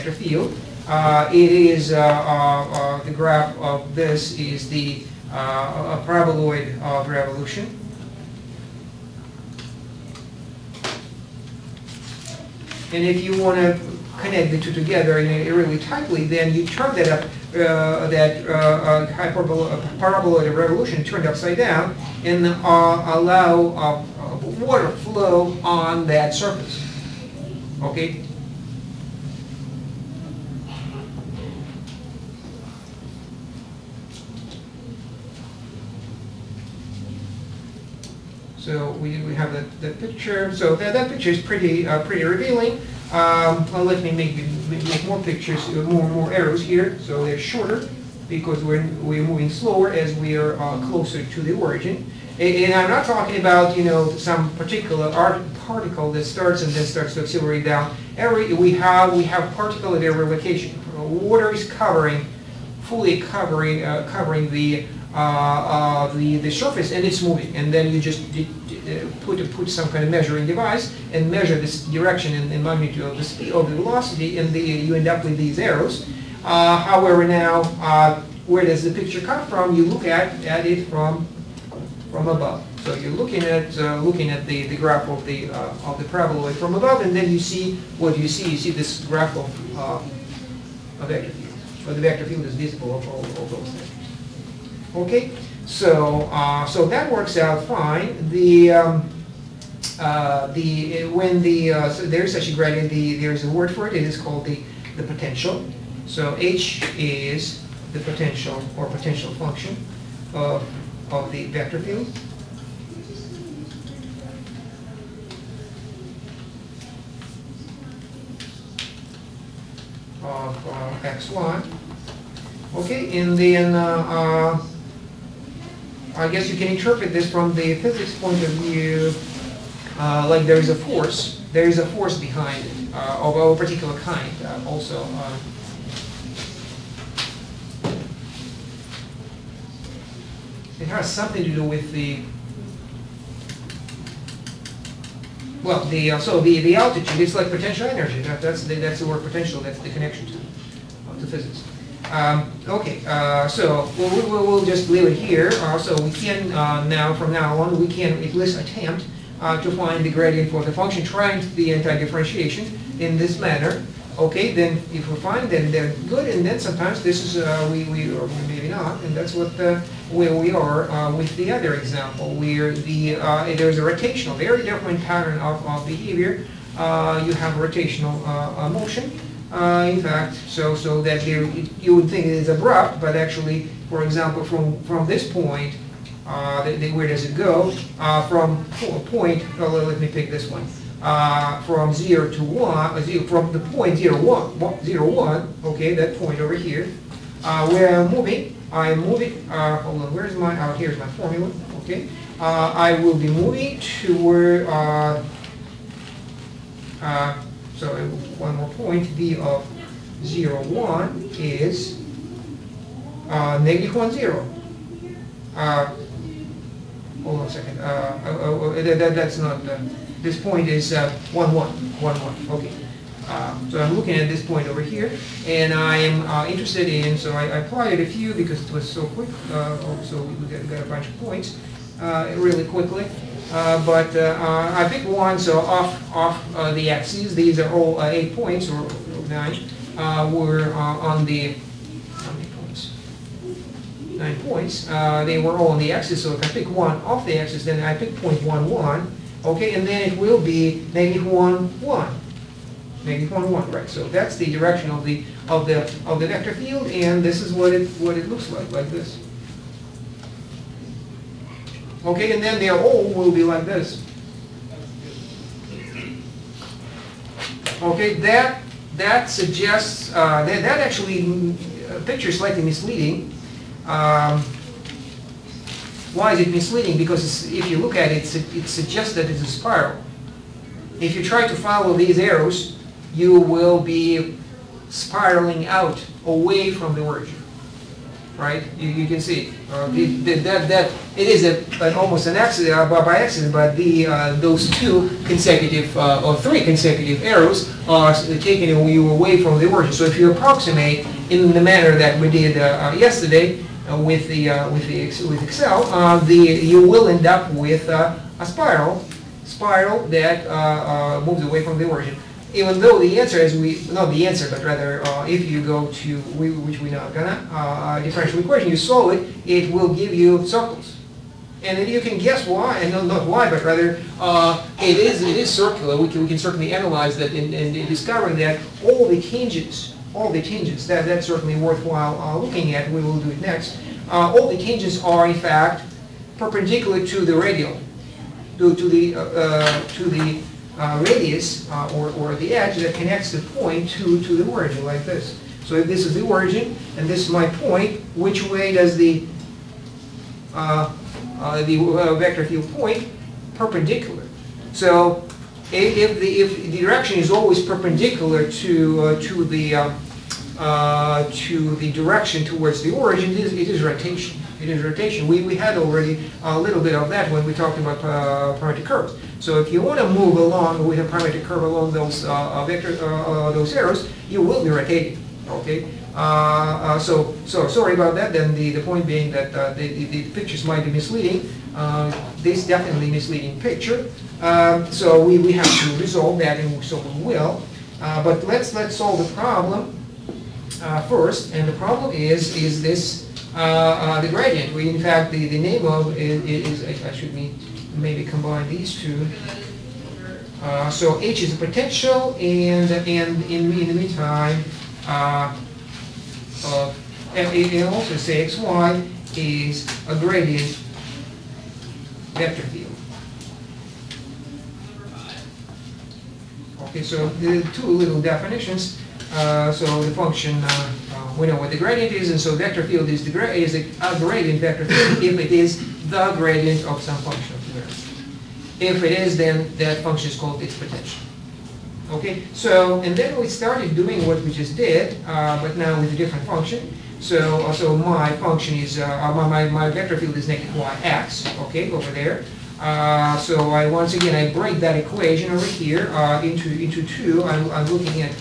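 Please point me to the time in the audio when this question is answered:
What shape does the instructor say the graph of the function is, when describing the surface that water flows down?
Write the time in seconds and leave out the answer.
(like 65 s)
6 s.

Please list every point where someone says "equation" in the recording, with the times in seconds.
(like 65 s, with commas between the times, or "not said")
318 s, 444 s.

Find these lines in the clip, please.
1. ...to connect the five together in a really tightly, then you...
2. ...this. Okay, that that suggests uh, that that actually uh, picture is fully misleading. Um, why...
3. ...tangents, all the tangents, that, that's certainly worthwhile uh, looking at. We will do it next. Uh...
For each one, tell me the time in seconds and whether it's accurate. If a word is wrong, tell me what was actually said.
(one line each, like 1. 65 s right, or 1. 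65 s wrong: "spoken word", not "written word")
1. 13 s wrong: "two", not "five"
2. 263 s wrong: "slightly", not "fully"
3. 329 s right.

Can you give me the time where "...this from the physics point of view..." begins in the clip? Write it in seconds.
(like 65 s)
127 s.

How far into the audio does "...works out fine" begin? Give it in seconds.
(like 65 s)
97 s.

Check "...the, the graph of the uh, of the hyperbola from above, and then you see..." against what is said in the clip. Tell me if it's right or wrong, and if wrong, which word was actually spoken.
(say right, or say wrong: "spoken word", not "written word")
wrong: "parabola", not "hyperbola".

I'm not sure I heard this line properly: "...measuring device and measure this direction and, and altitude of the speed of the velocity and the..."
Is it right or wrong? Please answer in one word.
wrong.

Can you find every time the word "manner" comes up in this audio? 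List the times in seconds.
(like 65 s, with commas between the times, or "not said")
163 s, 301 s.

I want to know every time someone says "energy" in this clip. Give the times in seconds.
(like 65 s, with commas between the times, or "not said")
147 s.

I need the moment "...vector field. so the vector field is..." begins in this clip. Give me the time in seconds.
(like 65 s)
91 s.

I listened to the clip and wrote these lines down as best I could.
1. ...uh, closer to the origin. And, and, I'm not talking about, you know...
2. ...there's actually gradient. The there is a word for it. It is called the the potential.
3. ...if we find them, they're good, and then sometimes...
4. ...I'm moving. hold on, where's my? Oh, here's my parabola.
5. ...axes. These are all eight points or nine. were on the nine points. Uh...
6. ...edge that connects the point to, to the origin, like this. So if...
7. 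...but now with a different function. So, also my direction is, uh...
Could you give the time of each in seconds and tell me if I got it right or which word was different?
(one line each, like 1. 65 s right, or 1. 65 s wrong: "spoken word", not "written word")
1. 50 s right
2. 102 s right
3. 164 s right
4. 198 s wrong: "formula", not "parabola"
5. 236 s right
6. 342 s right
7. 435 s wrong: "function", not "direction".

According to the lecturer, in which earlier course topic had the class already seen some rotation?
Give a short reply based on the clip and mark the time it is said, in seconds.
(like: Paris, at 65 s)
parametric curves, at 368 s.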